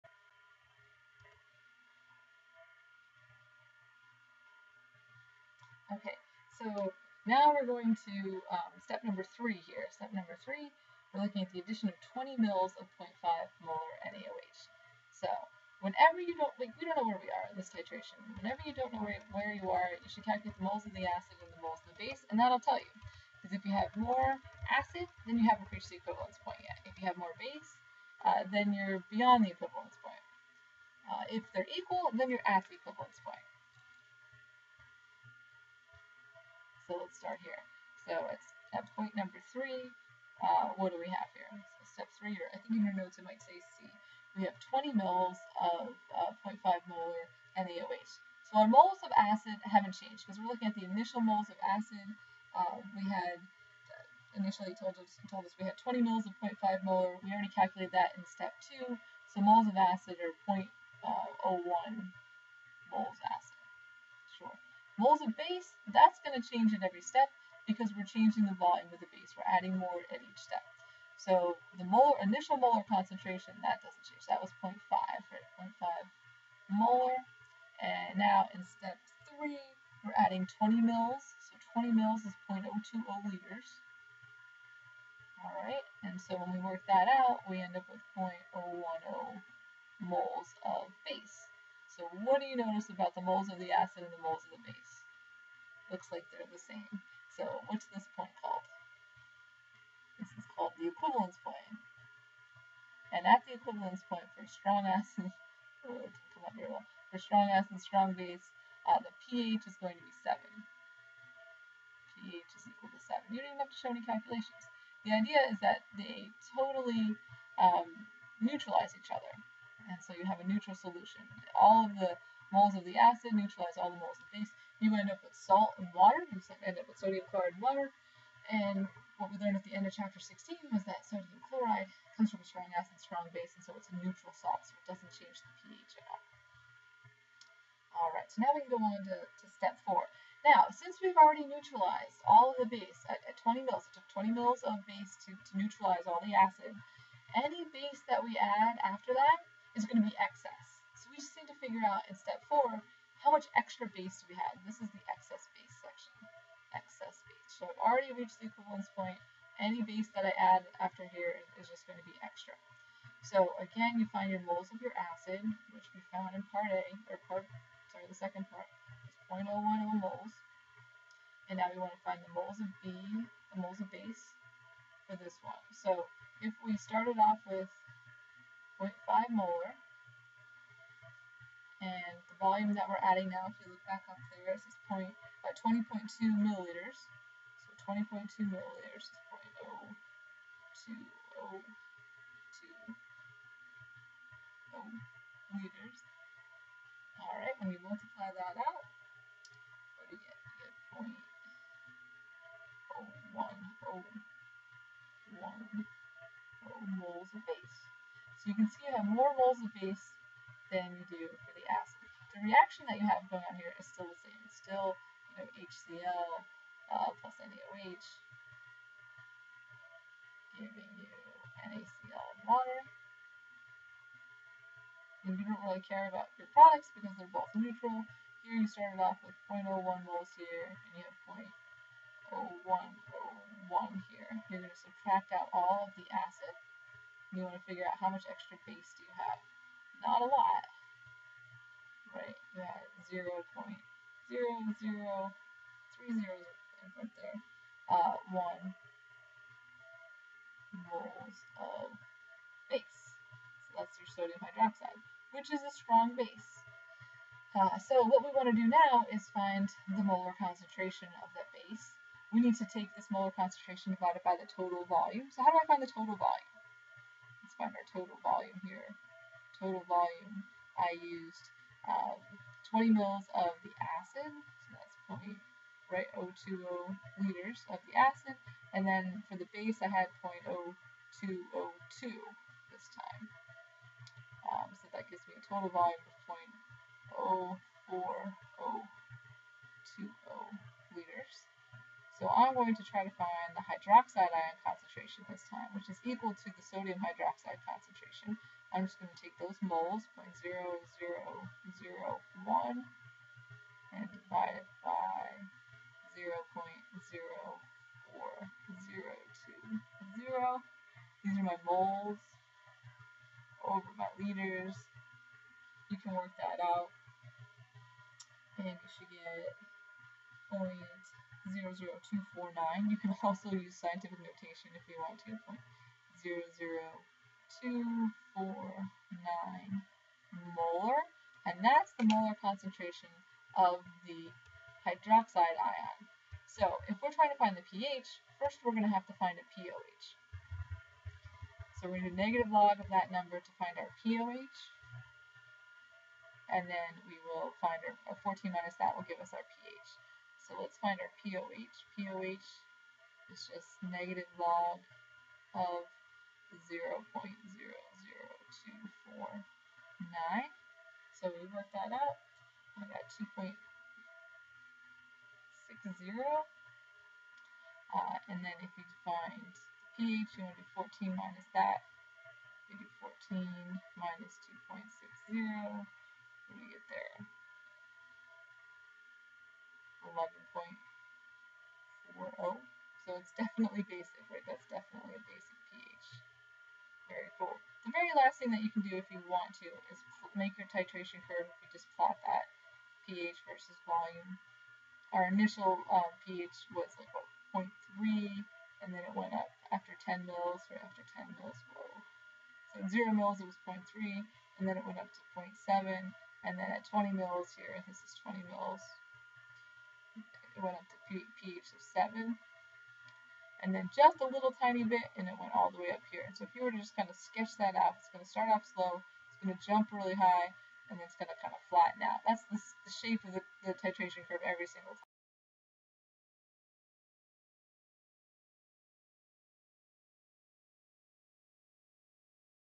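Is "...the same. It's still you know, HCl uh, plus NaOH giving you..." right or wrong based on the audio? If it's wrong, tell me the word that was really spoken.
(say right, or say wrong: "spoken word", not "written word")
right.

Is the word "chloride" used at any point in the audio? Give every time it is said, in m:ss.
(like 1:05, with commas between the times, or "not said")
2:07, 2:11.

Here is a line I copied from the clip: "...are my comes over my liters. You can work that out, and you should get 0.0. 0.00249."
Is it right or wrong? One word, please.
wrong.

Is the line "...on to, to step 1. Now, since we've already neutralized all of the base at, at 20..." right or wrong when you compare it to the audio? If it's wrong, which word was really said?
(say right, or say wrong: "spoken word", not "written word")
wrong: "4", not "1".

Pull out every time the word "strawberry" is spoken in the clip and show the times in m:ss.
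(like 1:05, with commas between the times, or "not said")
not said.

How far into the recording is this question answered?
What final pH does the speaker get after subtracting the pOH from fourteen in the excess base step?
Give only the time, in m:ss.
6:20.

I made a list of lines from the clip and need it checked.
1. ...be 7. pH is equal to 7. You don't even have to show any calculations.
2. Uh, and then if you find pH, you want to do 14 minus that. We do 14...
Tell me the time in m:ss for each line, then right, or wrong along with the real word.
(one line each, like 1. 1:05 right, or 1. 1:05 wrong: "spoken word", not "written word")
1. 1:50 right
2. 6:07 right.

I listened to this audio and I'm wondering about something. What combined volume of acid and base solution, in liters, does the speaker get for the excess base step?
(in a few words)
0.0402 liters.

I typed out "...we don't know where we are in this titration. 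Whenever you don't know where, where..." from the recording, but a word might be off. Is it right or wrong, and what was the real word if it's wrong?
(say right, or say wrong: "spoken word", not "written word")
right.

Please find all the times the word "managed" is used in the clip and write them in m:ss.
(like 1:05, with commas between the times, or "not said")
not said.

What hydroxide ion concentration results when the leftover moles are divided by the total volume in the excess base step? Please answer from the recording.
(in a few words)
0.00249 M.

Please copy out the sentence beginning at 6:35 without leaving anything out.
Our initial um, pH was like what, 0.3, and then it went up after 10 mils, right after 10 mils, whoa.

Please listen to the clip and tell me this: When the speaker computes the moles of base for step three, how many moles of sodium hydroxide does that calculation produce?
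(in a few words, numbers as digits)
0.010 moles.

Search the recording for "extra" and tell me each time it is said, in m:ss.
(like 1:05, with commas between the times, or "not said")
2:33, 2:42, 3:58.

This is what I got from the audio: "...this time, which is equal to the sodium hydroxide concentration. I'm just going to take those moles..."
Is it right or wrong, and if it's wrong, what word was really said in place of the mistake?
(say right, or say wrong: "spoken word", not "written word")
right.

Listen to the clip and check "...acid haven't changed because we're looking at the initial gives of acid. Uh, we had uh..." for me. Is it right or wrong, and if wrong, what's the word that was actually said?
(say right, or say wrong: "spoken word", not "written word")
wrong: "moles", not "gives".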